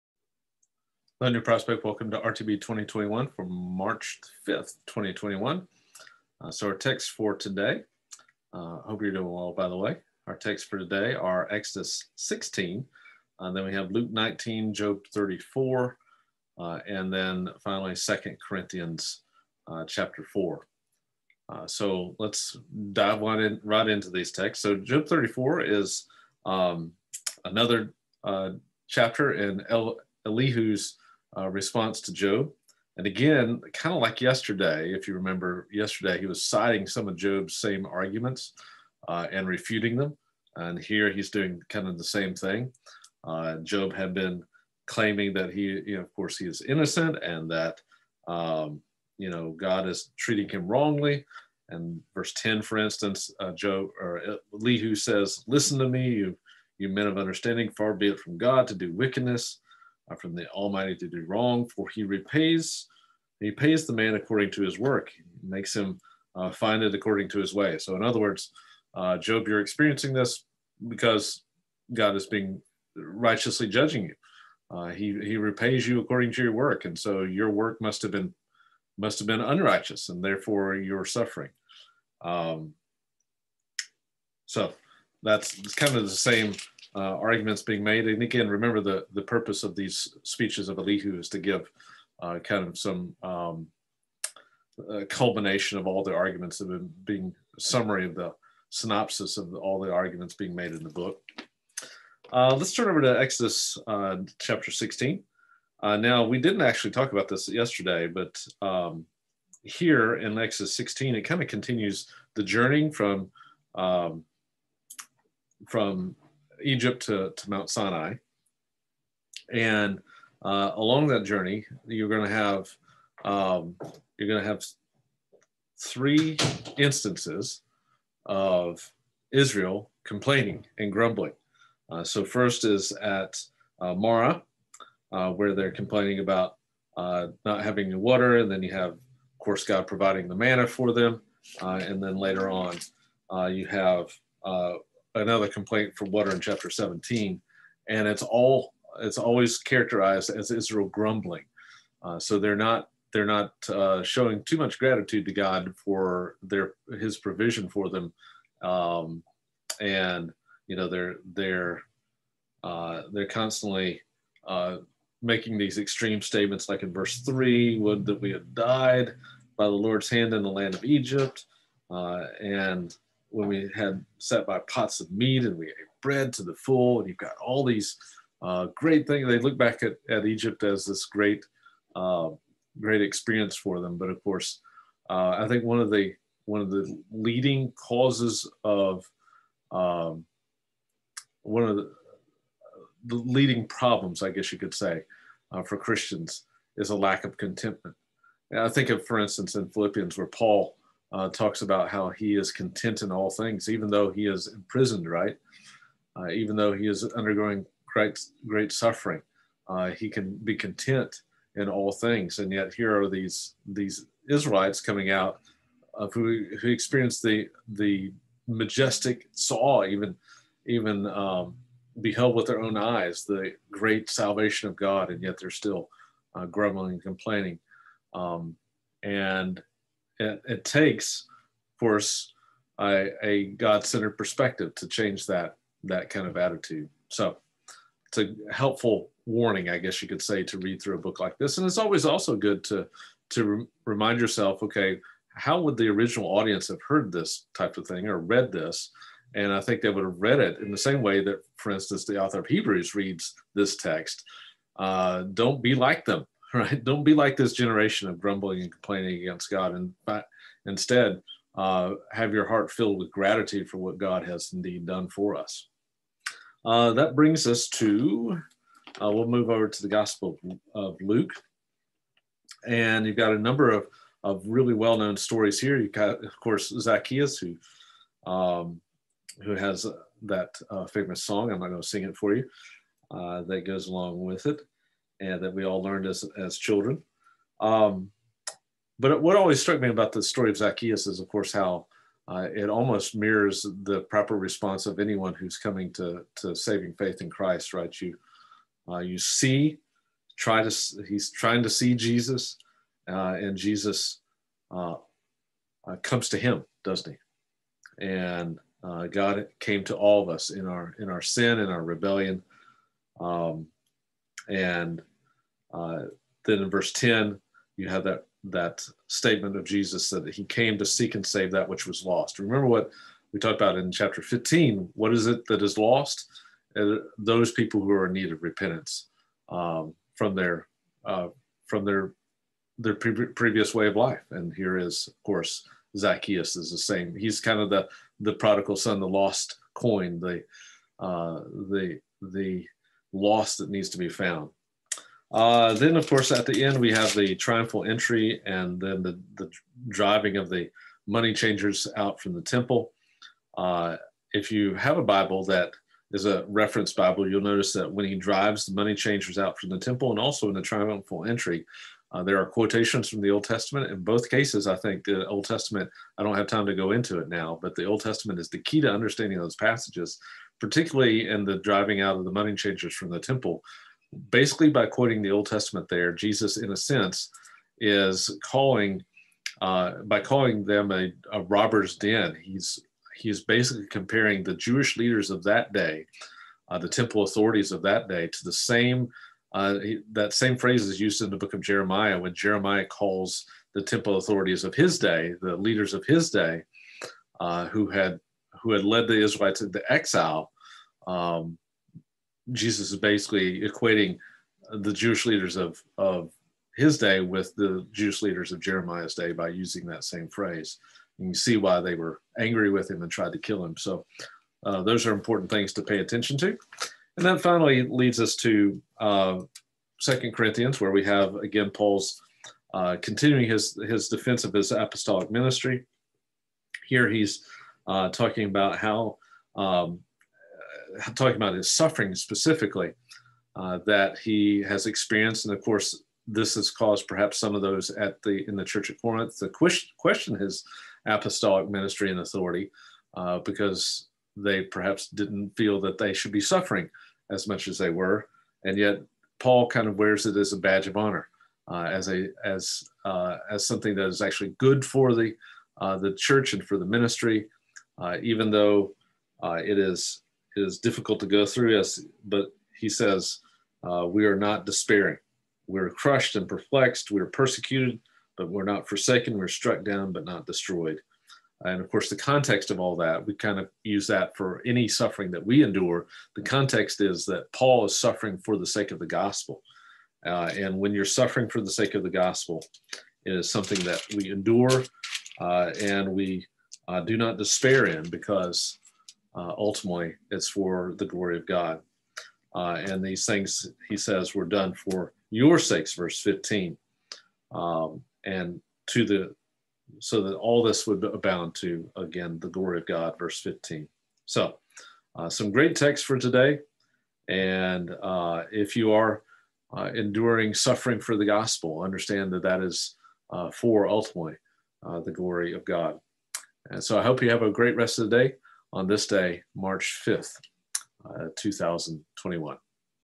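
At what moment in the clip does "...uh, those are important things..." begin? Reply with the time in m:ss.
6:54.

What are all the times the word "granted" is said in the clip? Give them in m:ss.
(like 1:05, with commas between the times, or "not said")
not said.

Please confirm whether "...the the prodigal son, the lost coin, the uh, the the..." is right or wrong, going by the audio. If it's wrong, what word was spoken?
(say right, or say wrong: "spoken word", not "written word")
right.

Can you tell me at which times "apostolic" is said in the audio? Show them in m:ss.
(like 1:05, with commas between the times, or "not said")
7:04, 7:21.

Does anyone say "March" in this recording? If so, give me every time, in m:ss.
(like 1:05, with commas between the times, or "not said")
0:03, 8:39.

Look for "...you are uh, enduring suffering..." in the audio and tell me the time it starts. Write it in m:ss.
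8:28.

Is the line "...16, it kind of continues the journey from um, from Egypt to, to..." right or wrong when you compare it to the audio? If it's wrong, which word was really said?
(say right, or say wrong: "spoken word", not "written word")
right.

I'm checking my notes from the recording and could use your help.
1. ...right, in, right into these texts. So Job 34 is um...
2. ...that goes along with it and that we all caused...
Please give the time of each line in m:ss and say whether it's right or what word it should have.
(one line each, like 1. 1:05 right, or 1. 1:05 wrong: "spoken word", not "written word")
1. 0:23 right
2. 4:43 wrong: "learned", not "caused".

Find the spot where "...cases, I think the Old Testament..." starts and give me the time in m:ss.
6:04.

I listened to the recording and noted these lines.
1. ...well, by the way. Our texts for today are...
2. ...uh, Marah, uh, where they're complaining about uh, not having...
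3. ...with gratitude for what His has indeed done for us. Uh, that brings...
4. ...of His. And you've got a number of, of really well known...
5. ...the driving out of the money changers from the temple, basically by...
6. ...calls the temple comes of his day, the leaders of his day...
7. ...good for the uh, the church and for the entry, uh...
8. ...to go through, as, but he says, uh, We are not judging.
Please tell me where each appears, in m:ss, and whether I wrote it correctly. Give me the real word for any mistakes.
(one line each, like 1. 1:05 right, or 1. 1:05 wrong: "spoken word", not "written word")
1. 0:09 right
2. 2:13 right
3. 4:22 wrong: "God", not "His"
4. 4:30 wrong: "Luke", not "His"
5. 6:11 right
6. 6:32 wrong: "authorities", not "comes"
7. 7:34 wrong: "ministry", not "entry"
8. 7:41 wrong: "despairing", not "judging".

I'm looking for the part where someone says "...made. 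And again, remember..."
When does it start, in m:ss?
1:27.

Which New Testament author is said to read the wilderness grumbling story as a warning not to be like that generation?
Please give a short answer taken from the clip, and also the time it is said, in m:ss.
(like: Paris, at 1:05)
the author of Hebrews, at 4:12.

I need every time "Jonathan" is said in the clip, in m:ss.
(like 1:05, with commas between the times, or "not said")
not said.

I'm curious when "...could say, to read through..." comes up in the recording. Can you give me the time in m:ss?
4:00.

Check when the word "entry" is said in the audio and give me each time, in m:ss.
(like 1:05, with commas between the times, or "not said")
5:47, 6:01.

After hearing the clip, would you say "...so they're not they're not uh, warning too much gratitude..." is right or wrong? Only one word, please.
wrong.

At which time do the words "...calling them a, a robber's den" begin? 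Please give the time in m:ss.
6:20.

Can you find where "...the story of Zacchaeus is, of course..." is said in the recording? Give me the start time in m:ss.
4:50.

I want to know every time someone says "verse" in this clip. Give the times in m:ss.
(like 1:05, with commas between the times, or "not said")
0:52, 2:46, 5:16, 8:15, 8:23.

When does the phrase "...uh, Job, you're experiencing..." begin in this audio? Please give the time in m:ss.
1:08.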